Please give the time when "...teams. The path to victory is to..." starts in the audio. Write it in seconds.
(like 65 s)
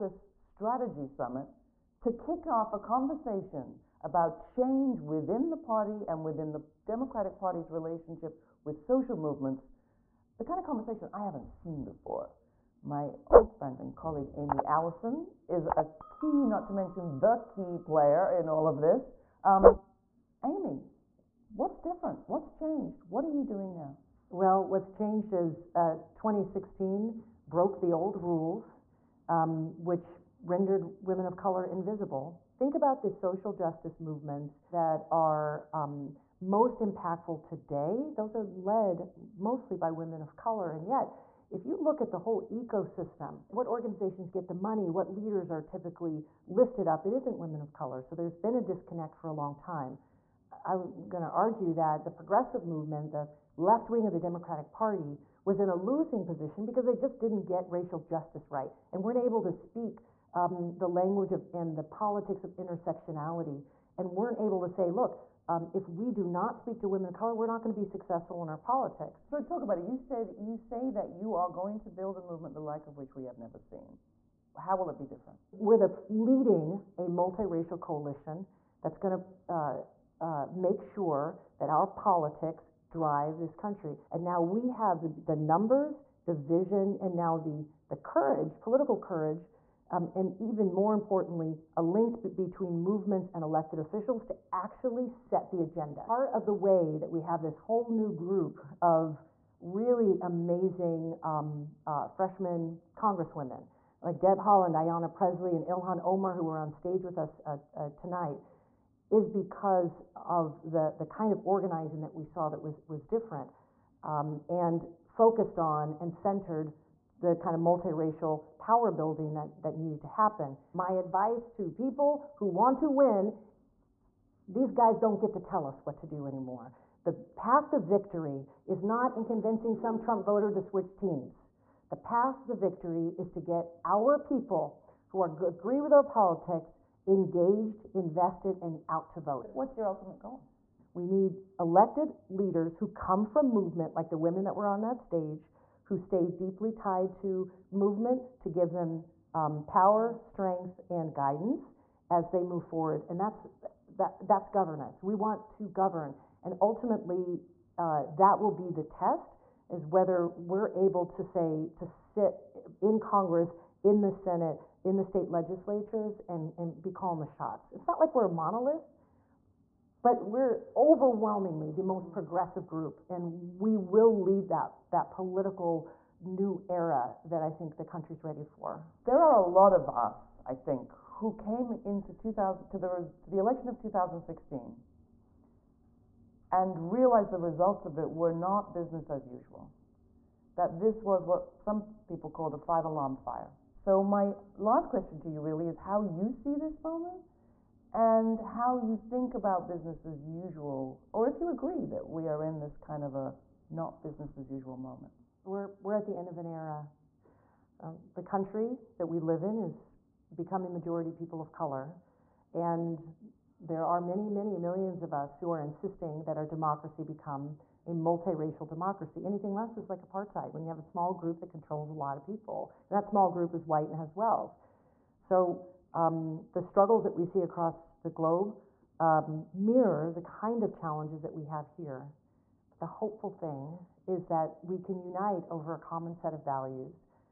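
130 s.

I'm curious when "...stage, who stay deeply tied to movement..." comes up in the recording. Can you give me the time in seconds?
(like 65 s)
145 s.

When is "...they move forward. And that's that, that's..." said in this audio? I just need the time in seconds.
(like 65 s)
152 s.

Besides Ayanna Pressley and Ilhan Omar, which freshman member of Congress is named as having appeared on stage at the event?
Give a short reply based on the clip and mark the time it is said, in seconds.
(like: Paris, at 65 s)
Deb Haaland, at 104 s.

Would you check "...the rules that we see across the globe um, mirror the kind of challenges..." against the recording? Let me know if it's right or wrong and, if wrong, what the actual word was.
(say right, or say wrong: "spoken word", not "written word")
wrong: "struggles", not "rules".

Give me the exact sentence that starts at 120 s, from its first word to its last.
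My advice to people who want to win these guys don't get to tell us what to do anymore.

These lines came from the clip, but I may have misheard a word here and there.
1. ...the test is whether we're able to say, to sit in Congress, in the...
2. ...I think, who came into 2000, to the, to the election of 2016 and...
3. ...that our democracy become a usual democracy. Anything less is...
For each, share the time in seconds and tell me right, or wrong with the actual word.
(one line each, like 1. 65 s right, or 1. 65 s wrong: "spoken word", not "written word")
1. 158 s right
2. 180 s right
3. 216 s wrong: "multiracial", not "usual".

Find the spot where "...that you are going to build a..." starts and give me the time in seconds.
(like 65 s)
70 s.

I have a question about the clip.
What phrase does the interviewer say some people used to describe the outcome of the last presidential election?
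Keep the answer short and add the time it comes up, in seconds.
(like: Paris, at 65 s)
five alarm fire, at 192 s.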